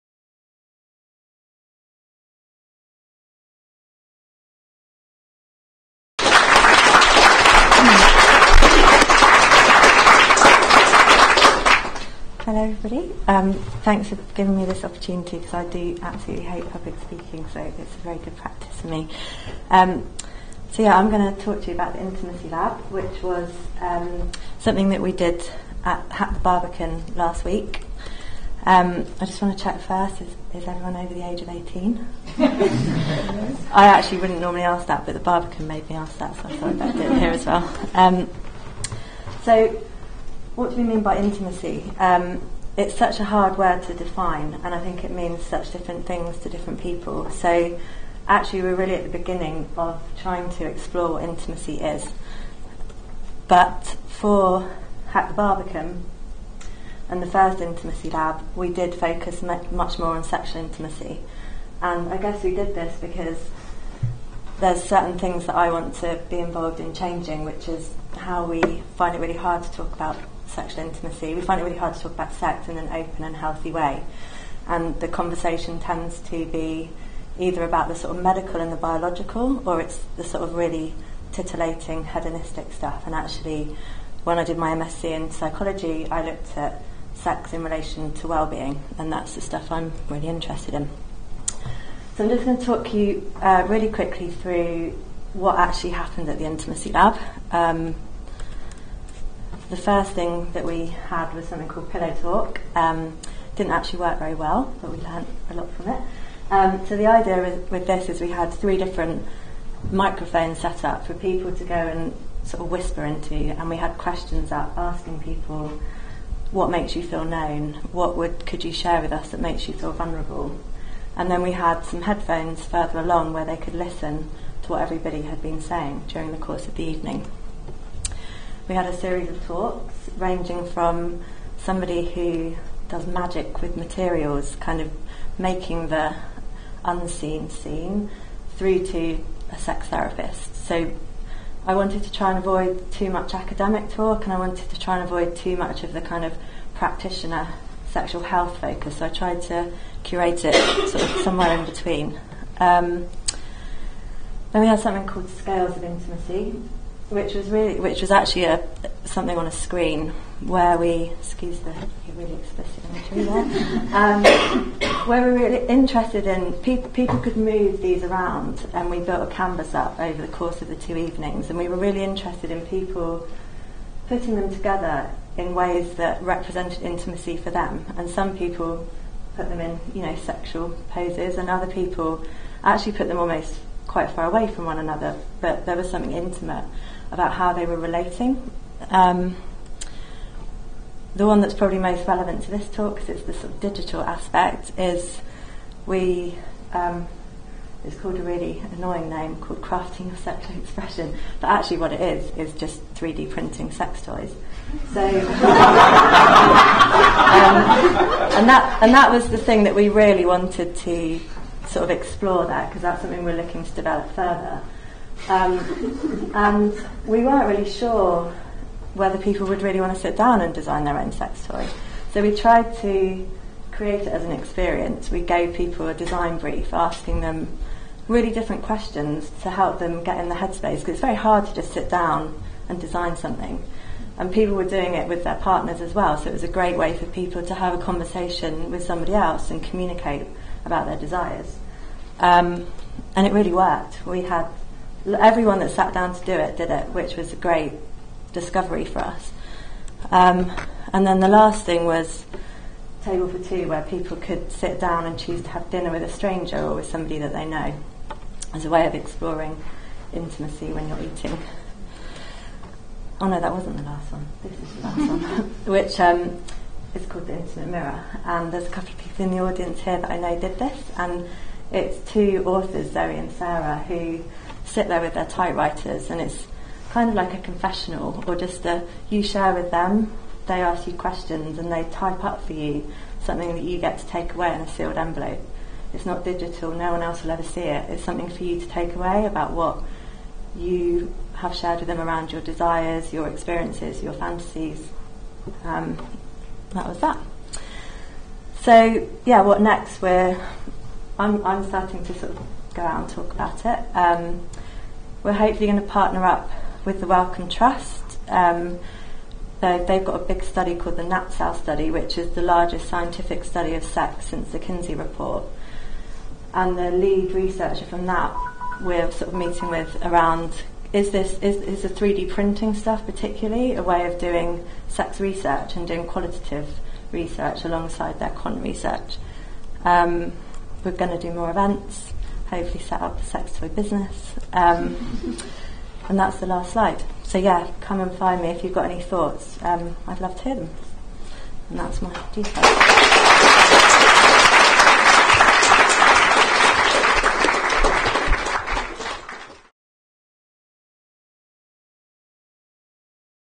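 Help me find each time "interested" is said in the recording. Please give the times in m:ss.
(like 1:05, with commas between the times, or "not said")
1:30, 2:45, 2:52.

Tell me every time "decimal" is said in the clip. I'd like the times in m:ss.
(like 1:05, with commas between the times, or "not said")
not said.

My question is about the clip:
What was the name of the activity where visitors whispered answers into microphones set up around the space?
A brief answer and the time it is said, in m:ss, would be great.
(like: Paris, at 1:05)
Pillow Talk, at 1:41.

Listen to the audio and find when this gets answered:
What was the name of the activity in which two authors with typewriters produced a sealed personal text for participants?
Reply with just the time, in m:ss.
4:27.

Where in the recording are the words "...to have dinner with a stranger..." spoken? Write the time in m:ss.
4:15.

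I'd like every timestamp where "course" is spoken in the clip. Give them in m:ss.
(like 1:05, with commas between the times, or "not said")
2:06, 2:50.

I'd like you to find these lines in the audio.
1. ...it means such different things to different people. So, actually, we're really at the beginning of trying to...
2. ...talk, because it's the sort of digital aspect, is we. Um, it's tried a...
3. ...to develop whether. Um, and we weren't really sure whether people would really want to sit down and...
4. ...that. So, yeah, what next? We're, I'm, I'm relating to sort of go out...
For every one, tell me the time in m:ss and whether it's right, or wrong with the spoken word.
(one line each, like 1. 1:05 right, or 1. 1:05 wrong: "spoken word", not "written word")
1. 0:45 right
2. 3:12 wrong: "called", not "tried"
3. 3:33 wrong: "further", not "whether"
4. 4:56 wrong: "starting", not "relating".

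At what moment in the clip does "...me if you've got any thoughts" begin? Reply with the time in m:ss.
5:38.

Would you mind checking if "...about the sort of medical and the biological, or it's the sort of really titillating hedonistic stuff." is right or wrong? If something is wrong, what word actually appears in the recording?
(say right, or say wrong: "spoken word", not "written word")
right.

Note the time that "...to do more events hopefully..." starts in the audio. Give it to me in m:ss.
5:31.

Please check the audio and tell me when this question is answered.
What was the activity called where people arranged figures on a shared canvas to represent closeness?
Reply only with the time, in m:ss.
2:35.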